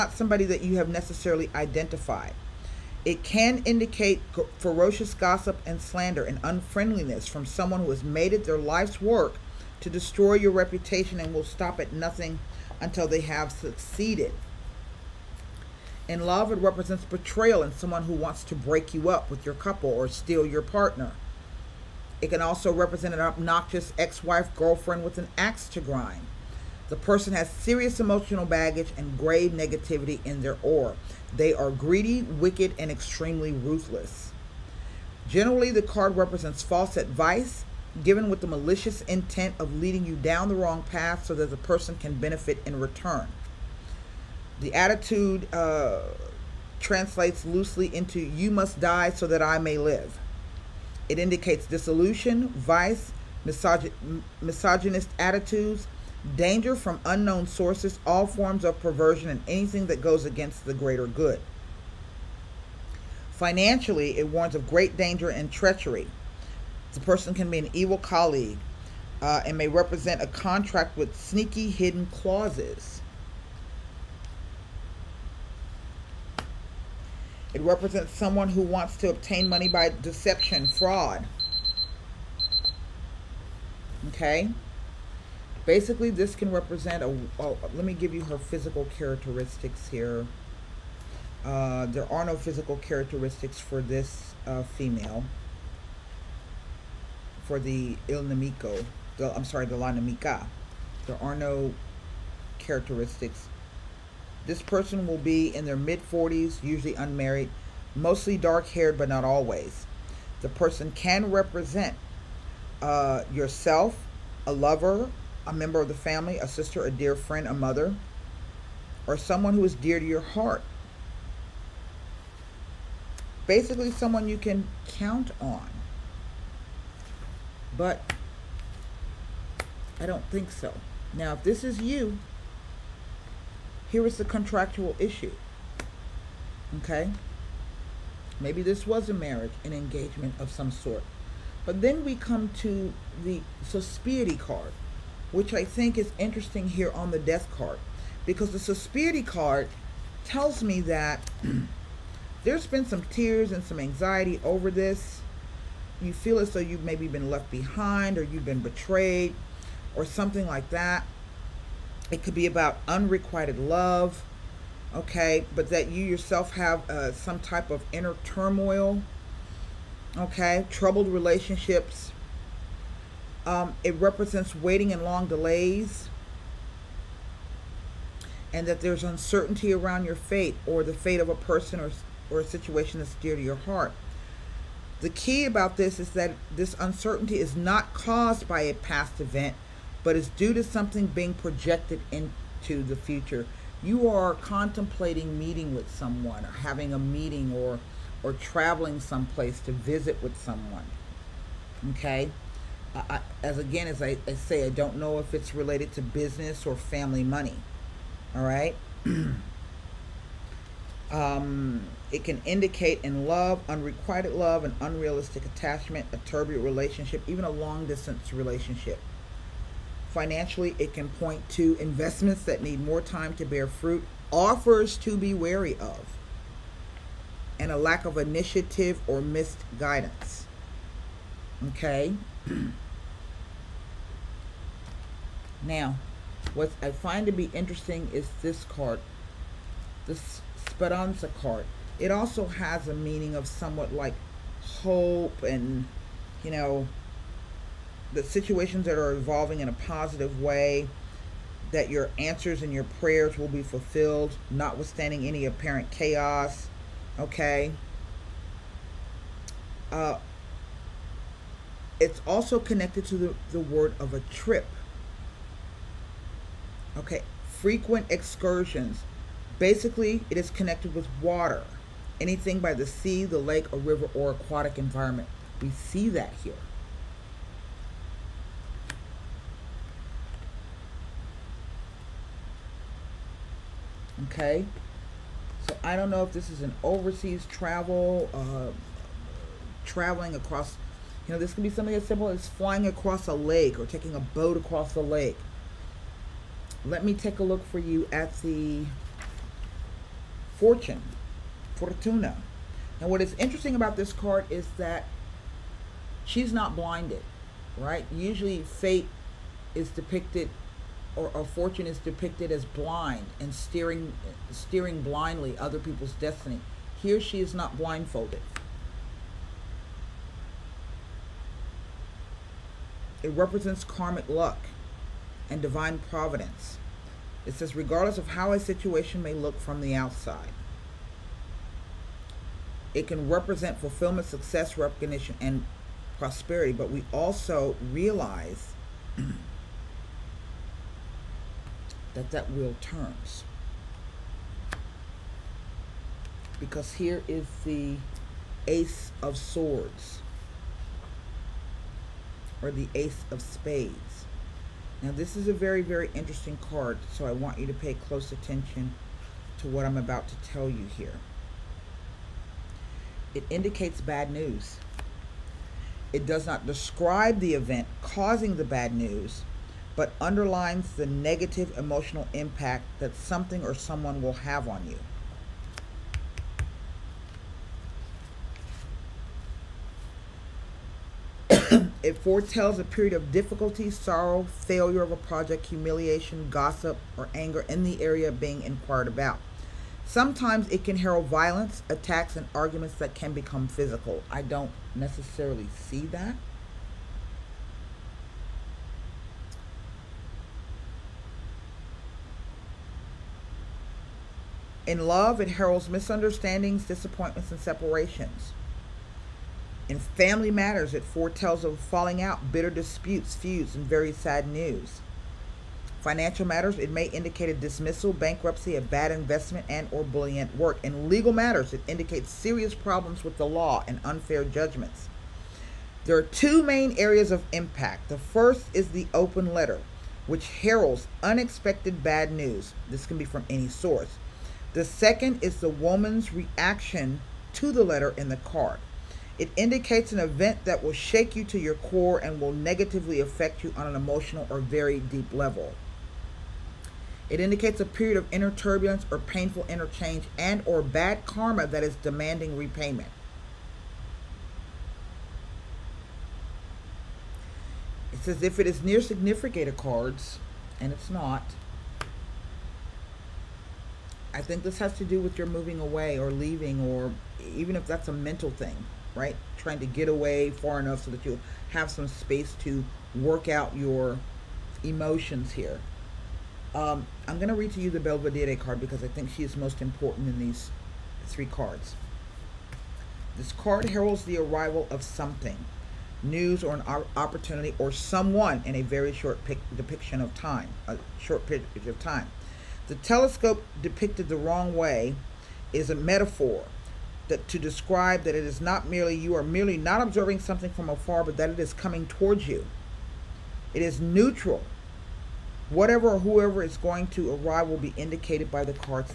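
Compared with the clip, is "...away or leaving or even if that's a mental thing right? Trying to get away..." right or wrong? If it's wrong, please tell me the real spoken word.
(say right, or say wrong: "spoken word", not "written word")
right.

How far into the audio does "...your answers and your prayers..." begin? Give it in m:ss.
4:11.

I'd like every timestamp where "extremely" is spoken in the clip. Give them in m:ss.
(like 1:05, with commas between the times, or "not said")
0:32.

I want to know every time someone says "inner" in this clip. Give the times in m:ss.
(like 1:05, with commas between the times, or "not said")
2:47, 7:28.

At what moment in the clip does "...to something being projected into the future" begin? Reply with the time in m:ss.
3:10.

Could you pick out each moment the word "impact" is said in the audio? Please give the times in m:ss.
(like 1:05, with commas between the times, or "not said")
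6:12, 7:07.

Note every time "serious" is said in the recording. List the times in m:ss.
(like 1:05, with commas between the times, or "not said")
0:27, 7:02.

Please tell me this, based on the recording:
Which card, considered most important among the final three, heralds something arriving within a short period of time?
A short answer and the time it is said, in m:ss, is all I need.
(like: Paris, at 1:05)
Belvedere, at 7:57.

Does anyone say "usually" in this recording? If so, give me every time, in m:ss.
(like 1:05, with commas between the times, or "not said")
1:46, 5:08.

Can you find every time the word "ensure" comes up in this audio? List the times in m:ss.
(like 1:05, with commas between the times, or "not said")
not said.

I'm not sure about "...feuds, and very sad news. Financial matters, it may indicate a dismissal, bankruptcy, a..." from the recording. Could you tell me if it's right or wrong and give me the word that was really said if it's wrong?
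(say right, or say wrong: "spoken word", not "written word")
right.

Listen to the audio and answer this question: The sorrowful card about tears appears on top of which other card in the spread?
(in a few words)
the death card.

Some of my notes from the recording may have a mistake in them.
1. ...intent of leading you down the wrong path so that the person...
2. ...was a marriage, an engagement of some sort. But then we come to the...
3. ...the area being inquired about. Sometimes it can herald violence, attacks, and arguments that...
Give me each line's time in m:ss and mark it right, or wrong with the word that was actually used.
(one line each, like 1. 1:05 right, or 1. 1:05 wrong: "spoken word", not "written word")
1. 0:39 right
2. 2:18 right
3. 6:27 right.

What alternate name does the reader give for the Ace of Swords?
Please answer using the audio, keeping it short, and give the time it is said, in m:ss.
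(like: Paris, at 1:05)
Ace of Spades, at 5:52.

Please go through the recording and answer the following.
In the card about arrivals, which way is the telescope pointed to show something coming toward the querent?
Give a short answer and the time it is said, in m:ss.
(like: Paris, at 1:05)
the wrong way, at 8:14.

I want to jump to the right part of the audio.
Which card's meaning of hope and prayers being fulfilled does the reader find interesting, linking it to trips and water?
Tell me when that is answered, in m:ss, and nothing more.
4:00.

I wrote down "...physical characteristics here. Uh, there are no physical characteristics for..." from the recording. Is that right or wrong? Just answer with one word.
right.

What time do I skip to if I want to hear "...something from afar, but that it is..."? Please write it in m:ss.
8:20.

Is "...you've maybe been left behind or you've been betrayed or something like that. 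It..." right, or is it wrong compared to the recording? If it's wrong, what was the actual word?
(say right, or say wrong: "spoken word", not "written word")
right.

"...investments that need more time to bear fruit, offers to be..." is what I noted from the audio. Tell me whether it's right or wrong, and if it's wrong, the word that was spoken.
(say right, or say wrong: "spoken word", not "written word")
right.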